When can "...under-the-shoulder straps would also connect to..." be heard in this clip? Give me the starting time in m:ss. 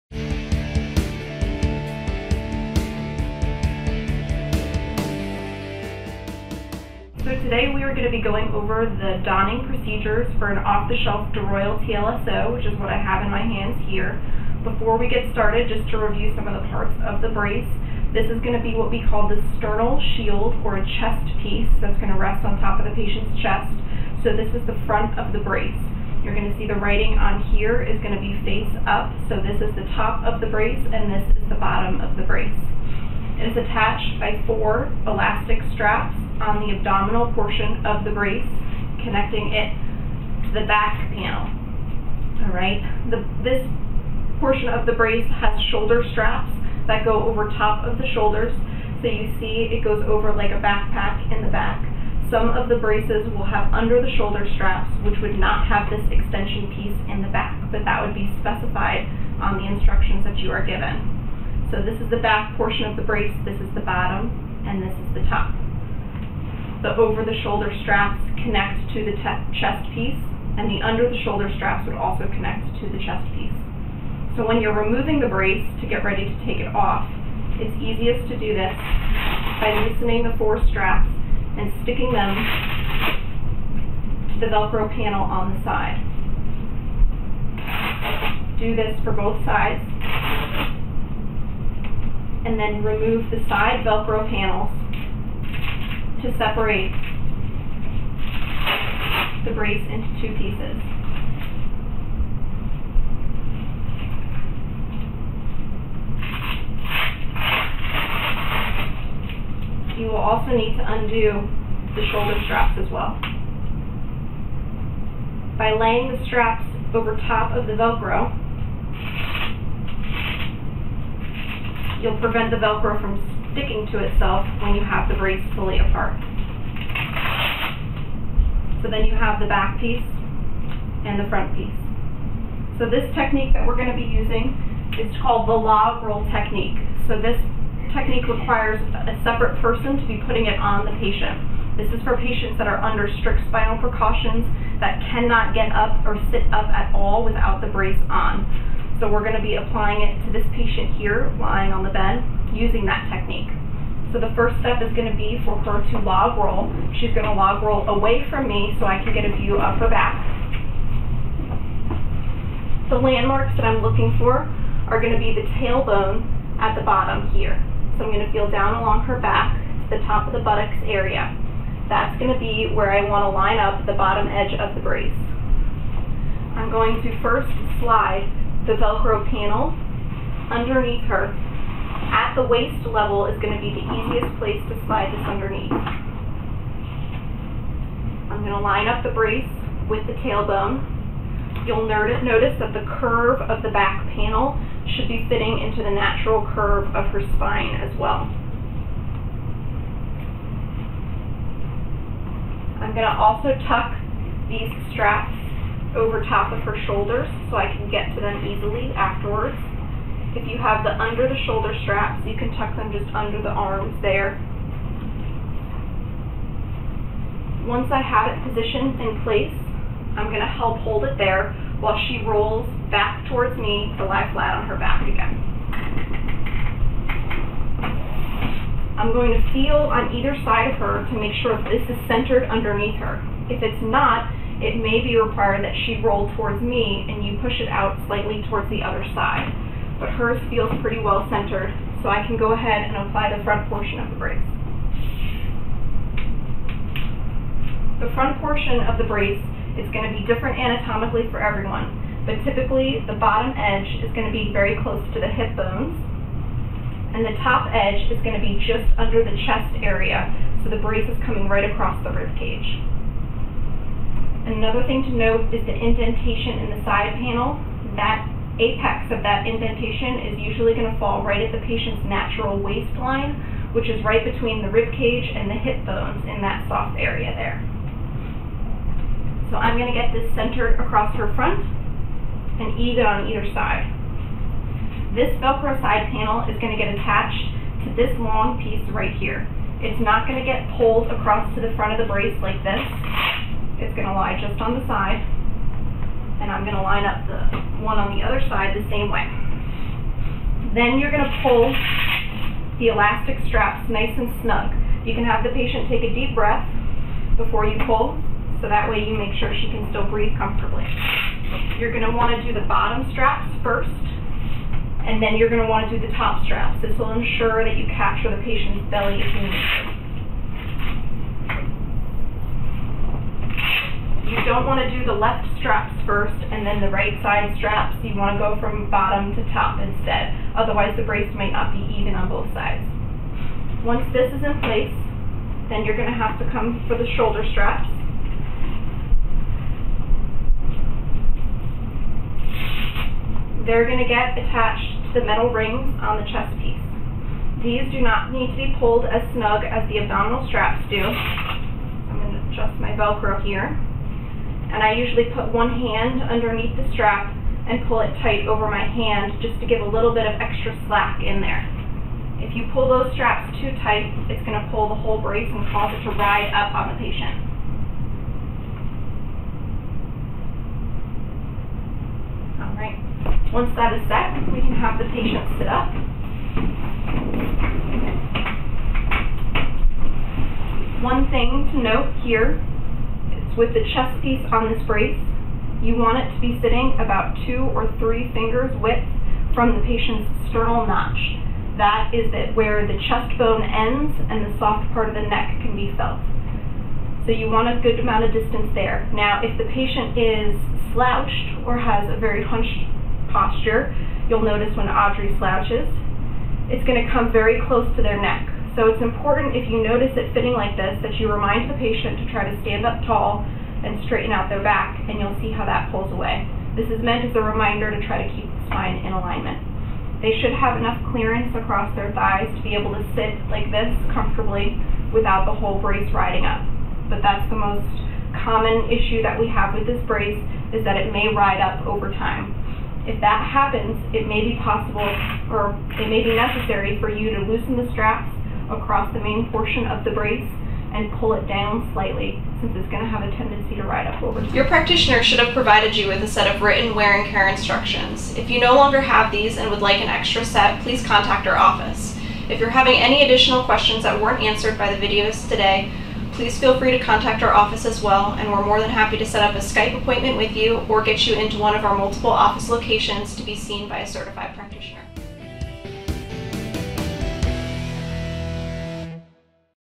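1:10.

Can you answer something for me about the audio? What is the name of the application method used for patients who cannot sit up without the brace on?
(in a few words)
log roll technique.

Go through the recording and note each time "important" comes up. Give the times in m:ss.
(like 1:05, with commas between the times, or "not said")
6:49.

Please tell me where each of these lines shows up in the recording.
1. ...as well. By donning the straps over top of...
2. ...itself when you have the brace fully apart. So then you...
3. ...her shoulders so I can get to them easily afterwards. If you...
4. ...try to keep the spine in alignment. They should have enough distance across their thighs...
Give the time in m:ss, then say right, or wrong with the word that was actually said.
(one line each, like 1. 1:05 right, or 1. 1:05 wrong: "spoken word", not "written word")
1. 1:52 wrong: "laying", not "donning"
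2. 2:04 right
3. 3:26 right
4. 6:58 wrong: "clearance", not "distance".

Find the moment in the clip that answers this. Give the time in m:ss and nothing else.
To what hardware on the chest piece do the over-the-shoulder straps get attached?
5:45.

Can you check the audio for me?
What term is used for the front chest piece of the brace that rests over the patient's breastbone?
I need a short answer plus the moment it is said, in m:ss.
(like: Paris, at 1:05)
sternal shield, at 0:19.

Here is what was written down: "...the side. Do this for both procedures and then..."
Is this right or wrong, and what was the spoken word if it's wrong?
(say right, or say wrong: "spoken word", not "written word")
wrong: "sides", not "procedures".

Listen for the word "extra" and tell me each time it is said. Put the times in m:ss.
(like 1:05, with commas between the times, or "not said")
6:00, 7:30.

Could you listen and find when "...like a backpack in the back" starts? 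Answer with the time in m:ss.
0:50.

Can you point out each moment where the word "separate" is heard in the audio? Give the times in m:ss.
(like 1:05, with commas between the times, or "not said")
1:36, 2:19.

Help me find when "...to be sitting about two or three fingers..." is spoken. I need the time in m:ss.
6:26.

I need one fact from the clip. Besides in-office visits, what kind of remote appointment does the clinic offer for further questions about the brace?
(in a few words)
Skype appointment.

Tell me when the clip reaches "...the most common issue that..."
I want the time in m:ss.
7:07.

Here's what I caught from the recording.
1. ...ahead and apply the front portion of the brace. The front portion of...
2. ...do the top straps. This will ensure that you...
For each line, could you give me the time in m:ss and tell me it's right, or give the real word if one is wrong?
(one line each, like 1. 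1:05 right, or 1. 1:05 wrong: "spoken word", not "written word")
1. 4:02 right
2. 5:15 right.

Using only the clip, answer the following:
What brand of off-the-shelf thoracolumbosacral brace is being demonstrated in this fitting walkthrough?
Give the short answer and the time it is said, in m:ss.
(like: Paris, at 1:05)
DeRoyal, at 0:11.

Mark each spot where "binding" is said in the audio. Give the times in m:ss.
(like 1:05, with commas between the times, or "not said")
not said.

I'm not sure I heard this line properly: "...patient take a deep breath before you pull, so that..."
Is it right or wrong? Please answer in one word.
right.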